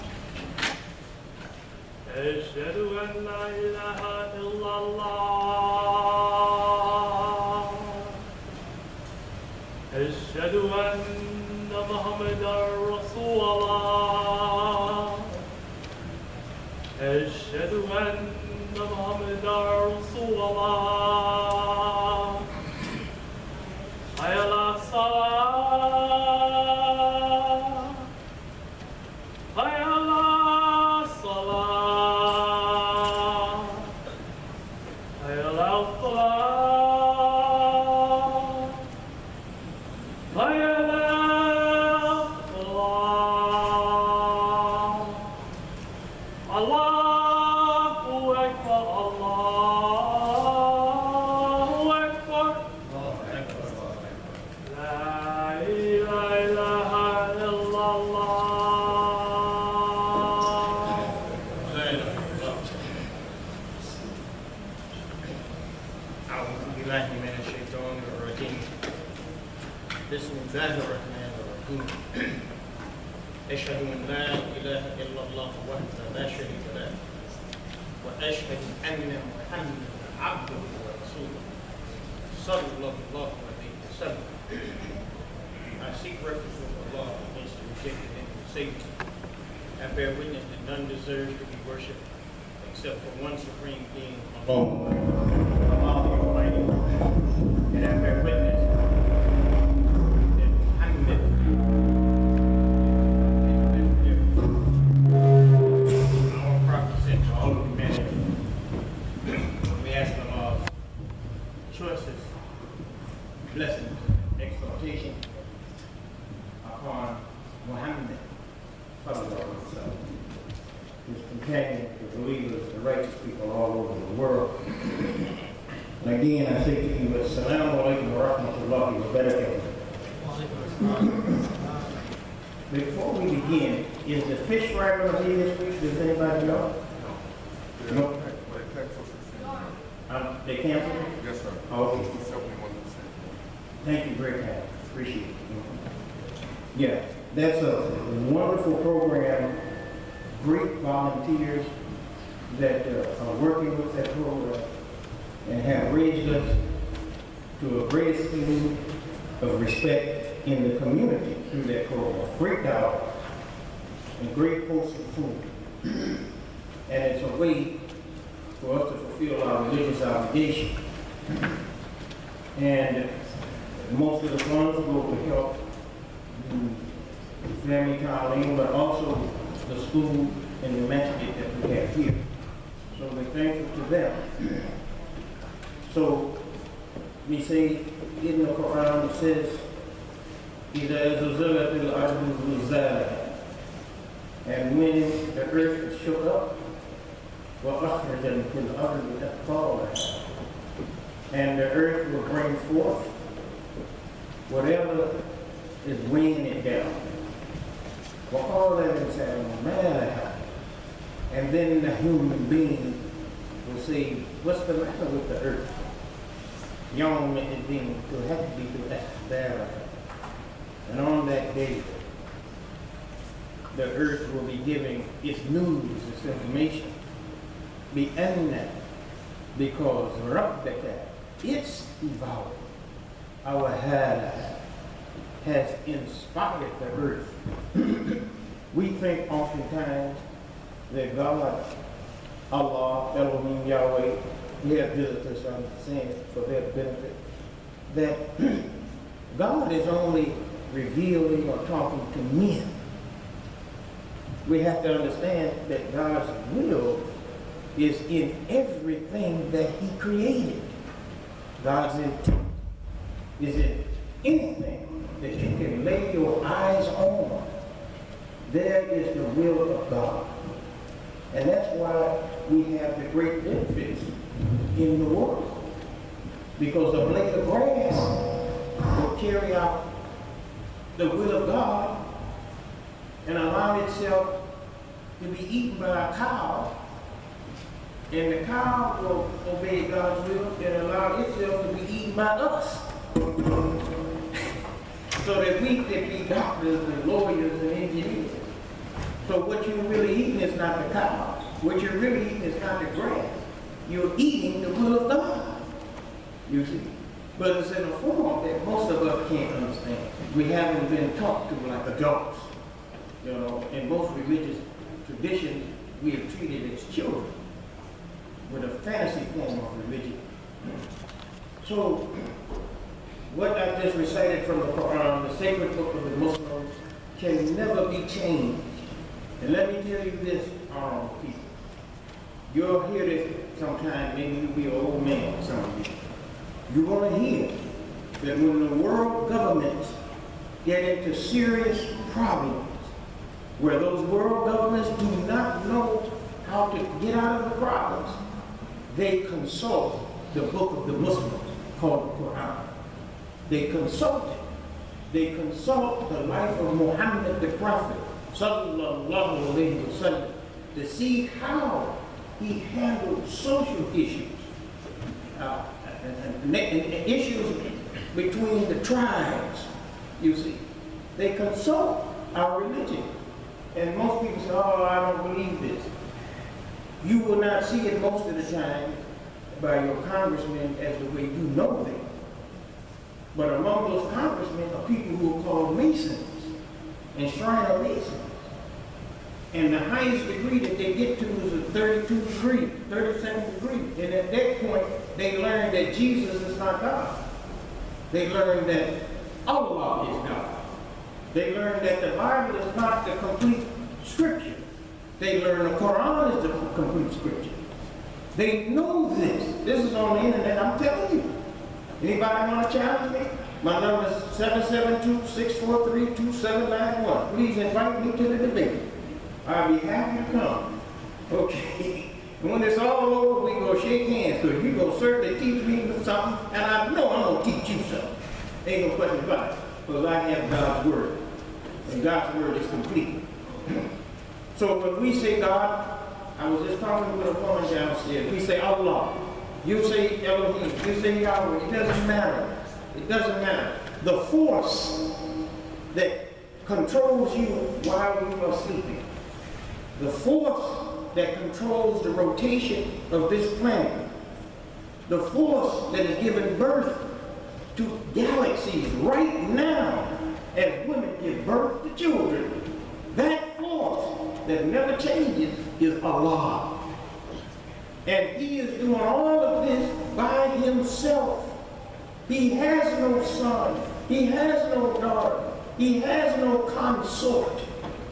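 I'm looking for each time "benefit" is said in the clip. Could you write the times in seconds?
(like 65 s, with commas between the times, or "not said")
246 s, 273 s.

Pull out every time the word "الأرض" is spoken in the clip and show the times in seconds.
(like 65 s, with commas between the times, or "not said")
191 s, 198 s.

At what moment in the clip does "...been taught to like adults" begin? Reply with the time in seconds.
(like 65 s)
310 s.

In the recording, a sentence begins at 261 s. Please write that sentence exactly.
God's intent is in anything that you can lay your eyes on, there is the will of God.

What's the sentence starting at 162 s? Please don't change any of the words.
Great dollars and great posts food.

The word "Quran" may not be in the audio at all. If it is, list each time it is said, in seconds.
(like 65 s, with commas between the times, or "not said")
188 s, 324 s, 352 s, 405 s.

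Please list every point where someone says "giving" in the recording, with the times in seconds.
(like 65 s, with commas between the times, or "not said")
224 s, 456 s.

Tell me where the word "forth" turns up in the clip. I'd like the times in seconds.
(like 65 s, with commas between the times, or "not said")
202 s.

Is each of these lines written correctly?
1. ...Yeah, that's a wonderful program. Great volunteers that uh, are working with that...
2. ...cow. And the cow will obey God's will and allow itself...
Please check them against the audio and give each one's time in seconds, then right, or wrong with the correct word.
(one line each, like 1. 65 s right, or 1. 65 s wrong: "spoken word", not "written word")
1. 146 s right
2. 286 s right.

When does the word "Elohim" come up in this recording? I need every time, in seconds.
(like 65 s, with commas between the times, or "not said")
243 s, 440 s.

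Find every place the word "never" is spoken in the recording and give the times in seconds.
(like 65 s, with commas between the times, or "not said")
327 s, 464 s.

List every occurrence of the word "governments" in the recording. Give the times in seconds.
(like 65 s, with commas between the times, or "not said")
339 s, 344 s.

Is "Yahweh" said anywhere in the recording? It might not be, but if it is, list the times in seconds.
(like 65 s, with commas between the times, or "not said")
243 s, 441 s.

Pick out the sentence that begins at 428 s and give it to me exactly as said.
Ain't no question about it, because I have God's Word.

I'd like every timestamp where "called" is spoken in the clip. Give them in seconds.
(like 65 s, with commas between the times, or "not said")
351 s, 385 s.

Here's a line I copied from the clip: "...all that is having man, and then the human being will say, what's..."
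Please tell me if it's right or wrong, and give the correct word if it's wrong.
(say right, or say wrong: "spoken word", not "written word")
right.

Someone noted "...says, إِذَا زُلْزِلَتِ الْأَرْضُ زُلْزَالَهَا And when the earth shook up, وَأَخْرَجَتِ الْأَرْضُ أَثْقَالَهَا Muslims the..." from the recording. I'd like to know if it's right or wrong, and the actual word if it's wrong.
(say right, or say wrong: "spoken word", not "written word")
wrong: "And", not "Muslims".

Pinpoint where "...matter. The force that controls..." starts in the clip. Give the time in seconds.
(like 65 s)
443 s.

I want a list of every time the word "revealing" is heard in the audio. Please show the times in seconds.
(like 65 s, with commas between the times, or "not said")
250 s.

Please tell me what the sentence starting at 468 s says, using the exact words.
And he is doing all of this by himself.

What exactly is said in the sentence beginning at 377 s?
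You will not see it most of the time by your congressmen as the way you know them.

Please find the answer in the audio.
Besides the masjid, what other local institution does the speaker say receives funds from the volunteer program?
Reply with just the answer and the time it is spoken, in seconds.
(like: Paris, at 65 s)
the school, at 179 s.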